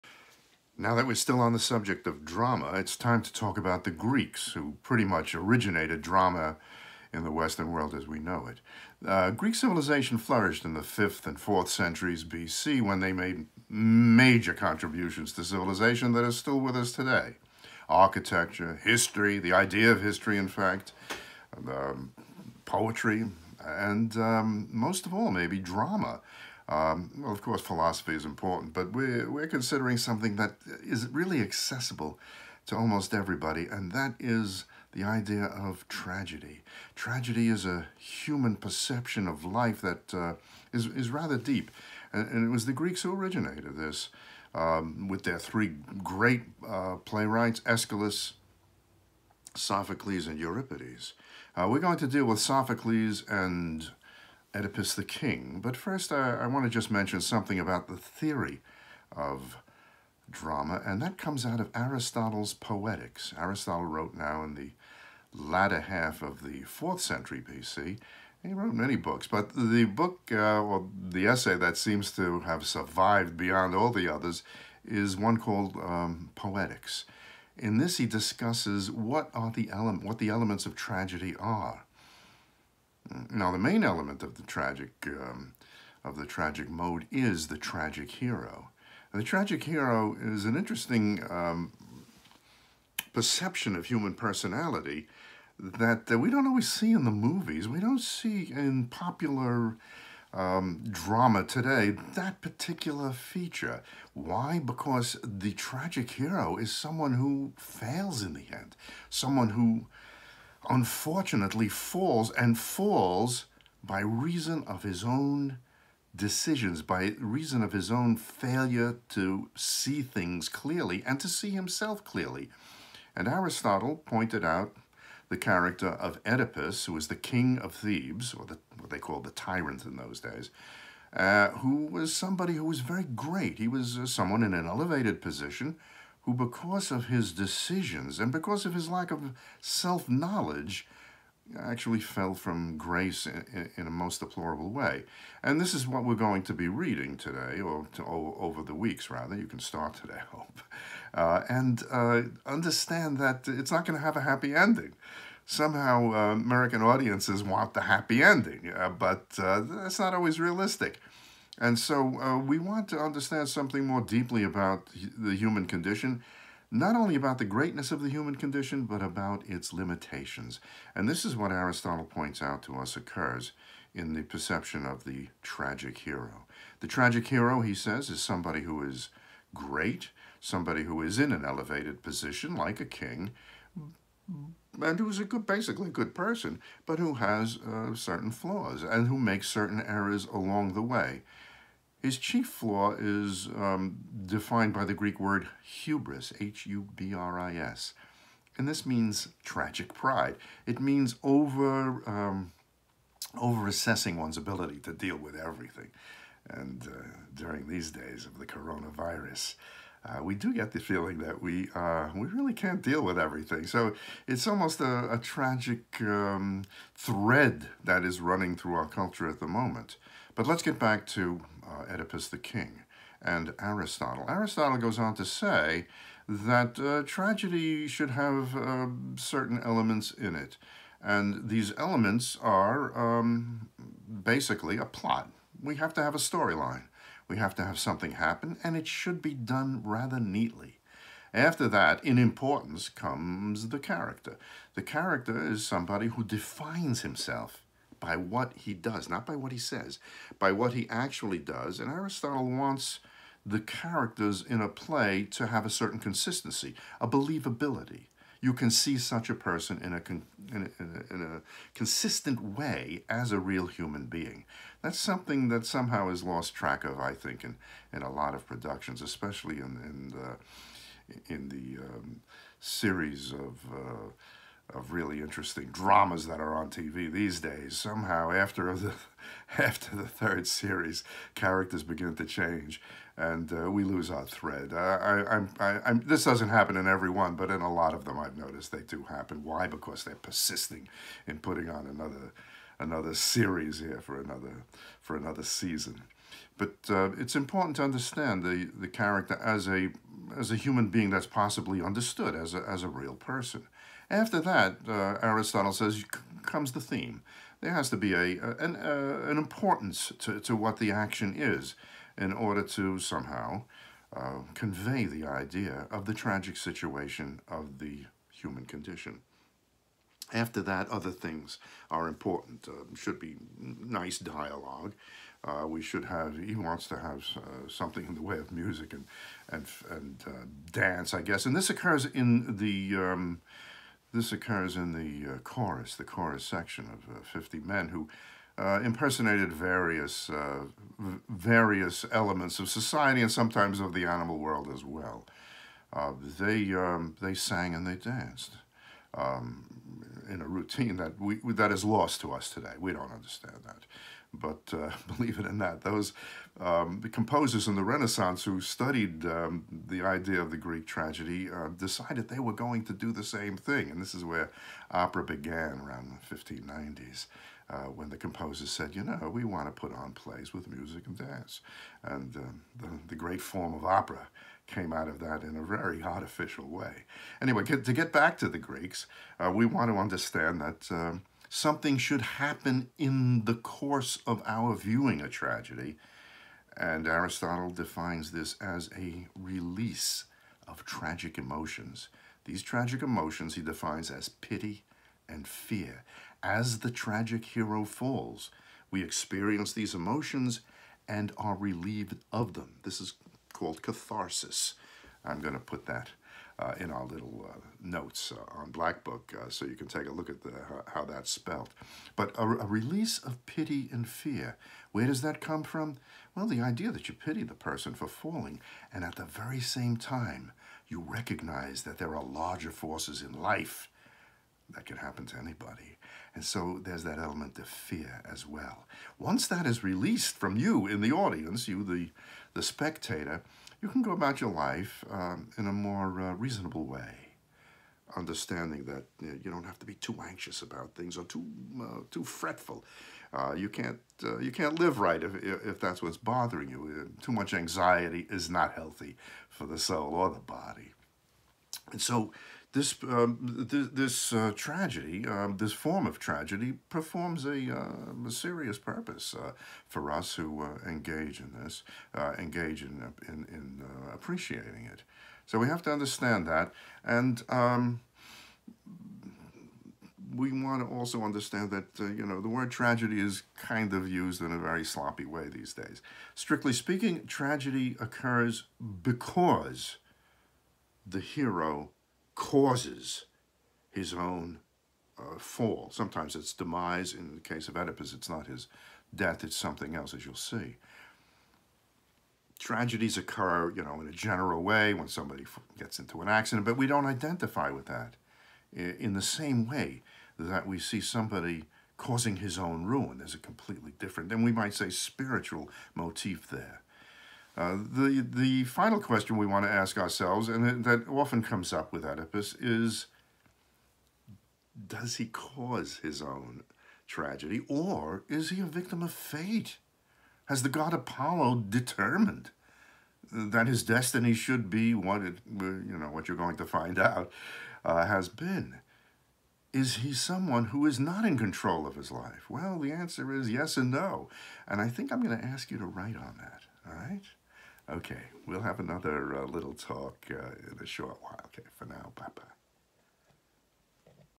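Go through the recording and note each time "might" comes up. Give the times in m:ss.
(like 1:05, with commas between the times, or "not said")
8:24.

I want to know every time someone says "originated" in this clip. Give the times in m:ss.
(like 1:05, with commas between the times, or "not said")
0:05, 0:43.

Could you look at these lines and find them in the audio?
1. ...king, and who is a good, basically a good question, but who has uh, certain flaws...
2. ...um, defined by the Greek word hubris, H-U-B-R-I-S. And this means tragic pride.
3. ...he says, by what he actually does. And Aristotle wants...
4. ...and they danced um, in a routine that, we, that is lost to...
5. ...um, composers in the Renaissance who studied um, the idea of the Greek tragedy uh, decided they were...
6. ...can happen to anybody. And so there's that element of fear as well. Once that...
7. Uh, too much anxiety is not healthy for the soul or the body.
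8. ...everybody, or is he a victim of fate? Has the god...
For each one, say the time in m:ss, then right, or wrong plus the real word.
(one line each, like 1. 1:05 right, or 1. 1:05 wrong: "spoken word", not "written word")
1. 3:02 wrong: "person", not "question"
2. 3:13 right
3. 4:09 right
4. 5:47 right
5. 5:56 right
6. 7:04 right
7. 7:27 right
8. 8:37 wrong: "tragedy", not "everybody".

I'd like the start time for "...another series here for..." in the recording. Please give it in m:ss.
4:52.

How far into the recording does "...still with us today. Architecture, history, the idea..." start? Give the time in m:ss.
0:16.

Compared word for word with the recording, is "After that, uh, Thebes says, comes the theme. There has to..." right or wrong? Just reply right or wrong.
wrong.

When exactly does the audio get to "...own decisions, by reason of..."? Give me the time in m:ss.
1:55.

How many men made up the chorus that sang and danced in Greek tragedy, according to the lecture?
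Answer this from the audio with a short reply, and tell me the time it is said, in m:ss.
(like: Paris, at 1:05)
50, at 5:37.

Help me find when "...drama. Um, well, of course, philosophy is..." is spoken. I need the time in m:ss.
0:25.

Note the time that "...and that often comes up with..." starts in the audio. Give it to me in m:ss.
8:30.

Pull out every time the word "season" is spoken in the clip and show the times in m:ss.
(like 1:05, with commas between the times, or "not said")
4:55.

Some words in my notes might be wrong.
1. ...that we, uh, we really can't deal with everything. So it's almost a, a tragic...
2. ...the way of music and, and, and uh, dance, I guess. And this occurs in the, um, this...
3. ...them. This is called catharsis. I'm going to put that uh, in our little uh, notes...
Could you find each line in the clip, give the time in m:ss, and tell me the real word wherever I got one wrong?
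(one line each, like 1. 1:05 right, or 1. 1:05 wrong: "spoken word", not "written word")
1. 3:31 right
2. 5:28 right
3. 6:42 right.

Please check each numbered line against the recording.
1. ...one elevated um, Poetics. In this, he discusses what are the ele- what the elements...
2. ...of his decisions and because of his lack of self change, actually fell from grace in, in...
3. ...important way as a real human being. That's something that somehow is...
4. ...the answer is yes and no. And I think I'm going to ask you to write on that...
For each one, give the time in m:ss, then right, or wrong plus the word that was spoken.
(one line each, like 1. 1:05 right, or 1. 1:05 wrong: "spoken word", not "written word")
1. 1:15 wrong: "called", not "elevated"
2. 2:16 wrong: "knowledge", not "change"
3. 4:21 wrong: "consistent", not "important"
4. 8:52 right.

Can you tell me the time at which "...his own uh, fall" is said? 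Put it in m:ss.
8:03.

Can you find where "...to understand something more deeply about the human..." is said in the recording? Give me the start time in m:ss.
2:42.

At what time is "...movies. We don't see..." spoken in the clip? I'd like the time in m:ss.
1:37.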